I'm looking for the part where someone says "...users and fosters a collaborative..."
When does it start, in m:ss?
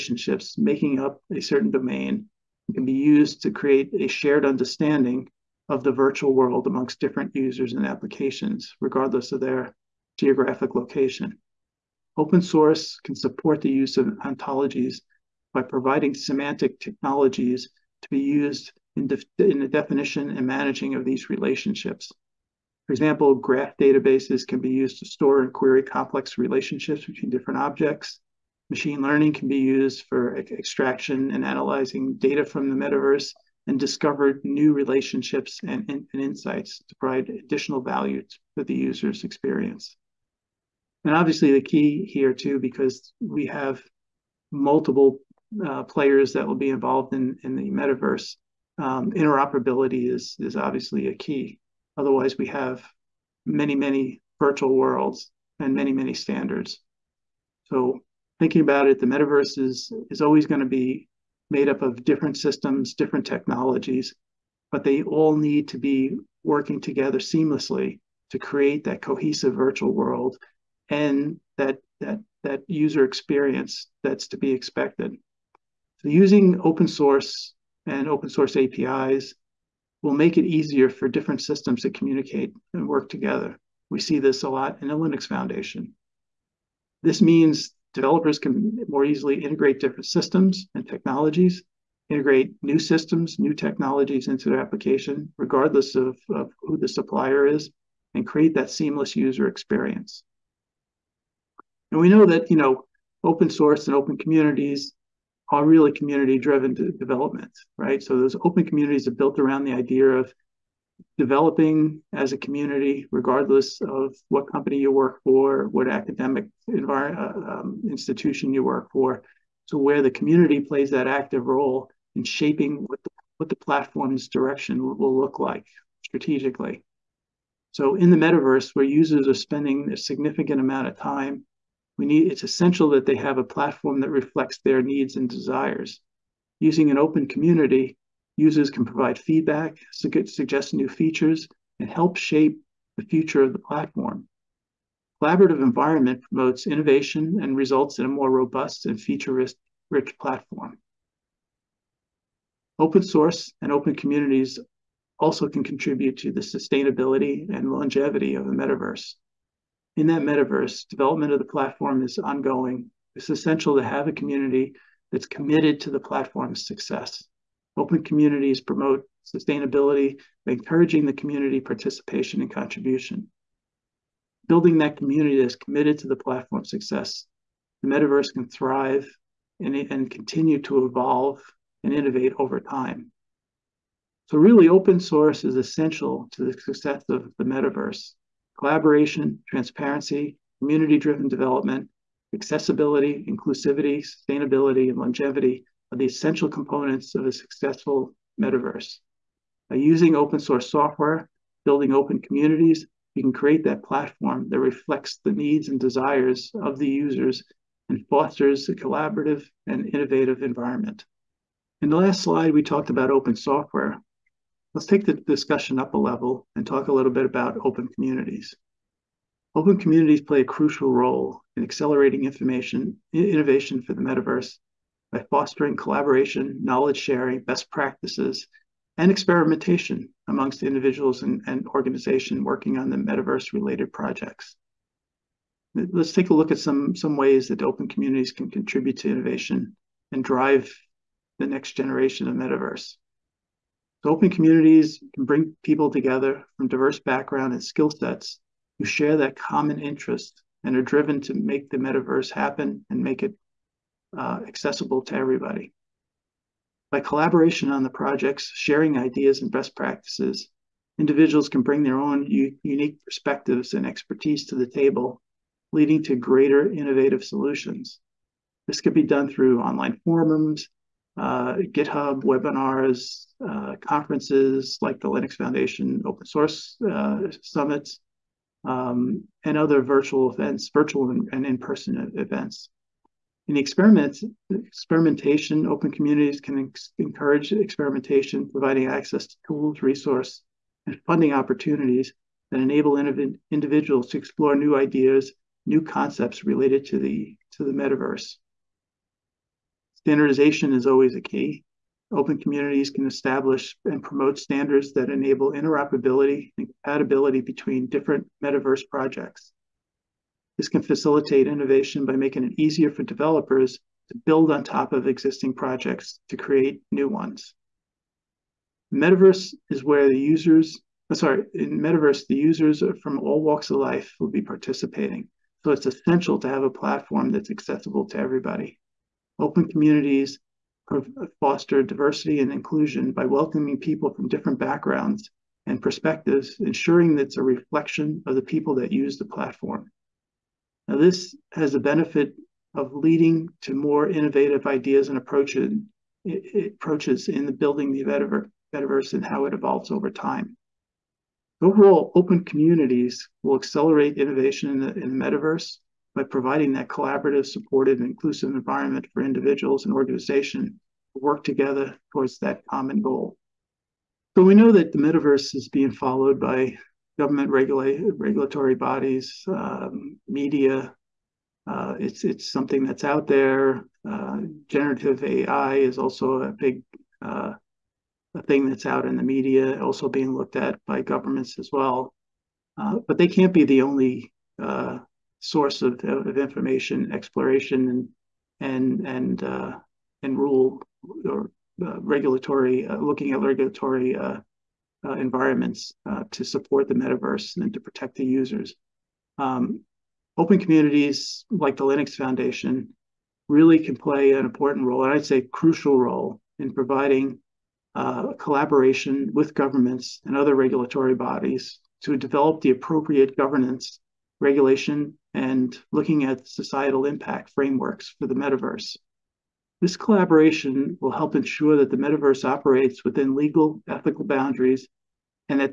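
3:26.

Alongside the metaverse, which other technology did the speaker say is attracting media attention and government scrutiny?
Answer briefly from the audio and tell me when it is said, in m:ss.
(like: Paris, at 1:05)
Generative AI, at 6:14.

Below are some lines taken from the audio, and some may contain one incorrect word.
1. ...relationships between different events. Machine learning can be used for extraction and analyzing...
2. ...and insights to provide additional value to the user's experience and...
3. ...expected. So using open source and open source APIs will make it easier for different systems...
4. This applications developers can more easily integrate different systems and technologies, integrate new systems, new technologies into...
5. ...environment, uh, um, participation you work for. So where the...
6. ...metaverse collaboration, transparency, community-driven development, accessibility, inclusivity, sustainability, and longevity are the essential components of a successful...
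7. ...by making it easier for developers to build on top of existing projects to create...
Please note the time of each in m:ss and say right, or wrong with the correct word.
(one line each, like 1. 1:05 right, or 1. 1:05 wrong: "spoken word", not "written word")
1. 0:26 wrong: "objects", not "events"
2. 0:35 right
3. 1:14 right
4. 1:27 wrong: "means", not "applications"
5. 1:56 wrong: "institution", not "participation"
6. 3:07 right
7. 5:12 right.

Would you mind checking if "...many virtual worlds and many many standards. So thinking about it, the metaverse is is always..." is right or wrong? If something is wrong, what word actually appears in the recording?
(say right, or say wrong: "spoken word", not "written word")
right.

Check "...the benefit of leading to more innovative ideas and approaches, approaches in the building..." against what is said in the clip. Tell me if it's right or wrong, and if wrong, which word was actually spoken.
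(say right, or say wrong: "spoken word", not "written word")
right.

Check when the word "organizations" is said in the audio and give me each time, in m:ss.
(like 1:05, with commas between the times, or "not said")
3:51, 5:59.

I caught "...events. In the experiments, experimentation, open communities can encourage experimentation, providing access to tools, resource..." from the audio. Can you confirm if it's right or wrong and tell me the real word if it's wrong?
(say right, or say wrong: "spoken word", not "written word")
right.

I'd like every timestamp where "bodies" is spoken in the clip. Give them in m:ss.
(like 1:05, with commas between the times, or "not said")
6:08, 6:51.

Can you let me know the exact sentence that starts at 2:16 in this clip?
Using an open community, users can provide feedback, suggest new features, and help shape the future of the platform.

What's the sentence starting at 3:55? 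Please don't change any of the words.
Let's take a look at some, some ways that open communities can contribute to innovation and drive the next generation of metaverse.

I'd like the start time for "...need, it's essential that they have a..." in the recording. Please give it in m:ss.
2:12.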